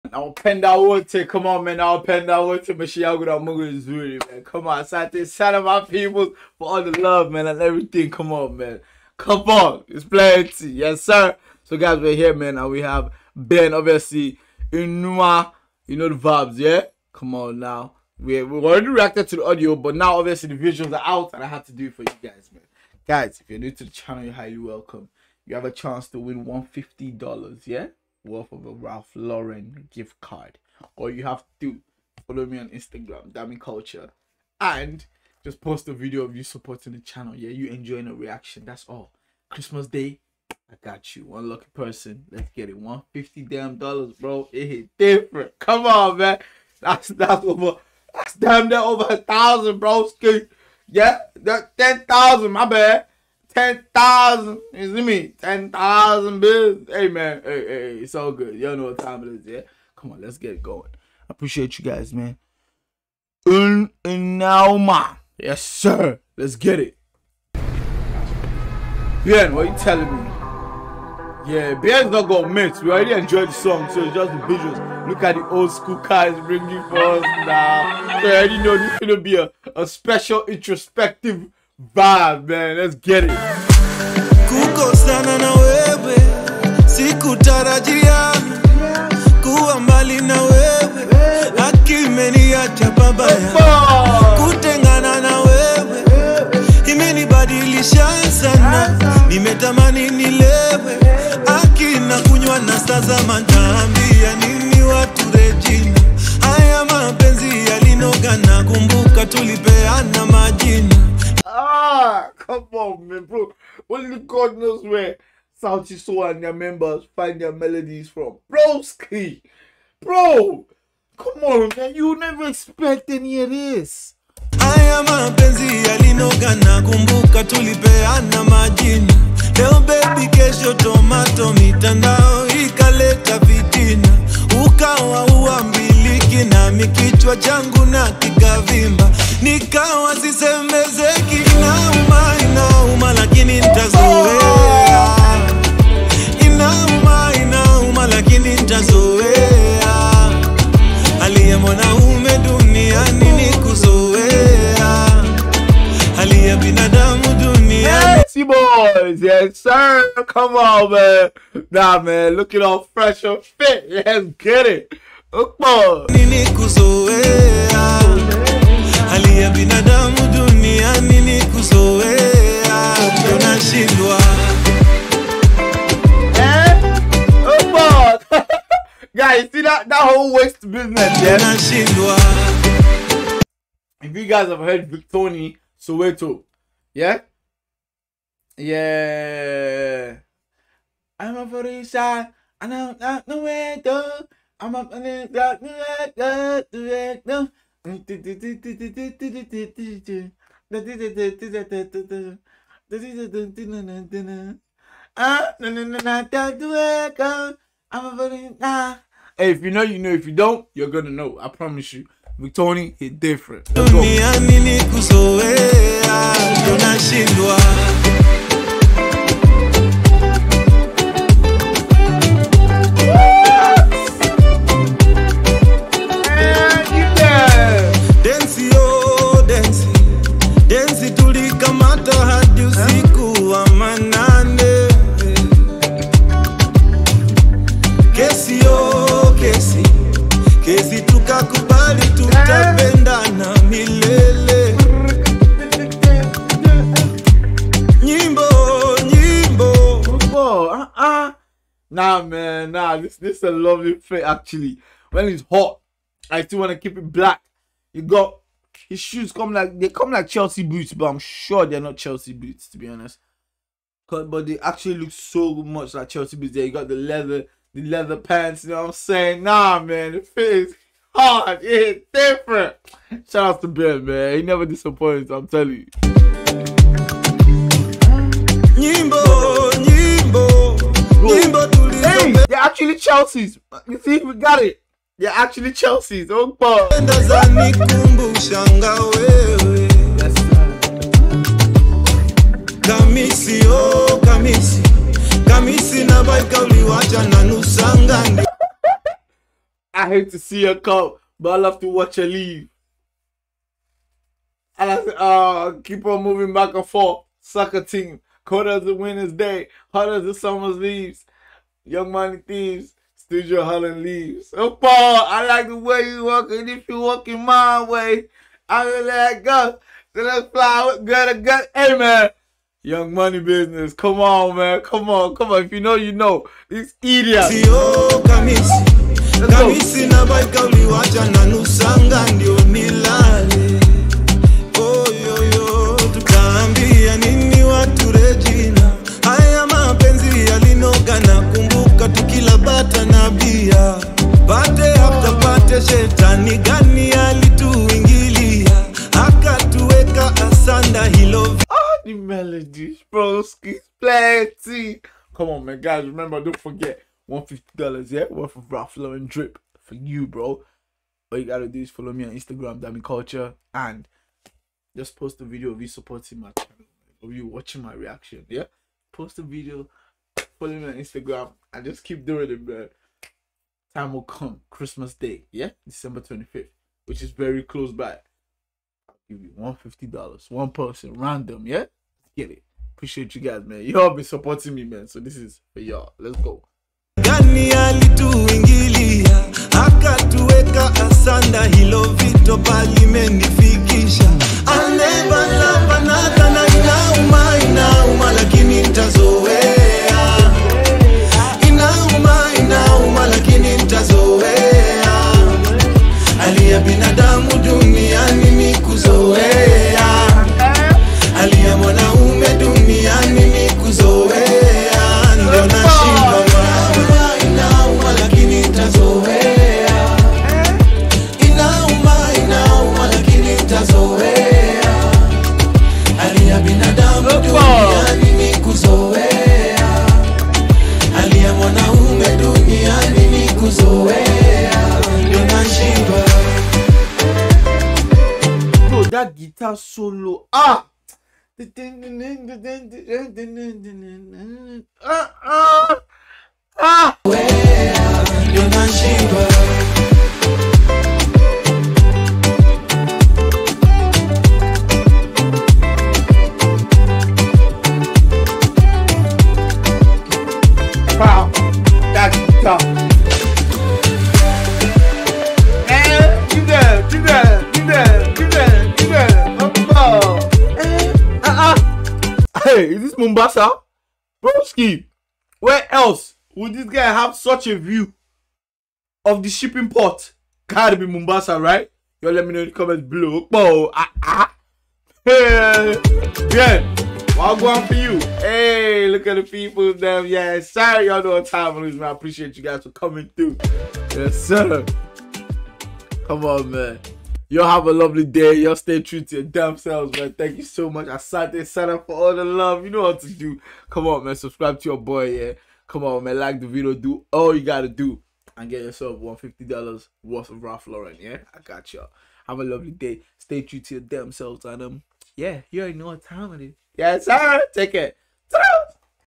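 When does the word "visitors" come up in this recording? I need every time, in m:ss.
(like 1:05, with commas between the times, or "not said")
not said.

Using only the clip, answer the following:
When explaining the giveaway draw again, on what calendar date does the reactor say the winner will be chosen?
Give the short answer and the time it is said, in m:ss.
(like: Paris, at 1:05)
December 25, at 6:15.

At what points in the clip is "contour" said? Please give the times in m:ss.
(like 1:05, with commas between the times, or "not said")
not said.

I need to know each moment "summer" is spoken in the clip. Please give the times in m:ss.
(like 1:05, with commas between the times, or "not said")
5:10.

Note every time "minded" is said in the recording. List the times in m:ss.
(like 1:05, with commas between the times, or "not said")
not said.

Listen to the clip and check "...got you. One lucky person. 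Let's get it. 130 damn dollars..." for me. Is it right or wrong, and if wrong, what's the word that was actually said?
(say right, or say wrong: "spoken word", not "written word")
wrong: "150", not "130".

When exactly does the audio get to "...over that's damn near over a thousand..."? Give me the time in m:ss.
0:47.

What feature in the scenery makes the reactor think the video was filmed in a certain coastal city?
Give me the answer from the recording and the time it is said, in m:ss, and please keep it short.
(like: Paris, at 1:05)
shipping port, at 7:59.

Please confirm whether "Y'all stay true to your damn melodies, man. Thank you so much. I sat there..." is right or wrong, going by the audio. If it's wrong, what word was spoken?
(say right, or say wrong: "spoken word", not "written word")
wrong: "selves", not "melodies".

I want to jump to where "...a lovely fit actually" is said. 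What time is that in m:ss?
4:13.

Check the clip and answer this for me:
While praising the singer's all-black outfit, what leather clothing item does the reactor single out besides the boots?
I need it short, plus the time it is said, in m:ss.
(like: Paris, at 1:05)
leather pants, at 4:27.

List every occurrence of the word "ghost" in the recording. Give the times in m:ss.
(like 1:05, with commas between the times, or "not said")
not said.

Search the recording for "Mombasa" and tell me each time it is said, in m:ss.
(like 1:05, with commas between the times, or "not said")
7:53, 8:01.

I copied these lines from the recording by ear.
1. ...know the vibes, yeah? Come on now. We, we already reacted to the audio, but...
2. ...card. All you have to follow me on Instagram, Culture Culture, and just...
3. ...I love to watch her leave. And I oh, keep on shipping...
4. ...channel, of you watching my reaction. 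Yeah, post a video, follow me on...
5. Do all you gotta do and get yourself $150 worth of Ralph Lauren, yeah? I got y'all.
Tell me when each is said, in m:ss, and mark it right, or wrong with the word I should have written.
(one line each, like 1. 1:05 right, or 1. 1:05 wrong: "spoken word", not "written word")
1. 0:15 right
2. 0:30 wrong: "Dami", not "Culture"
3. 5:01 wrong: "moving", not "shipping"
4. 6:06 right
5. 8:26 right.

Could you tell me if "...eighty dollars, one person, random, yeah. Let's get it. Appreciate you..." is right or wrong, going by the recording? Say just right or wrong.
wrong.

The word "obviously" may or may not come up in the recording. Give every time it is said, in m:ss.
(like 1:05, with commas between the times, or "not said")
0:13, 0:20.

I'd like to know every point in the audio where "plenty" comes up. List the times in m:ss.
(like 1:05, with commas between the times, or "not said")
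0:10.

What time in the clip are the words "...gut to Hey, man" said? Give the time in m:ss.
5:21.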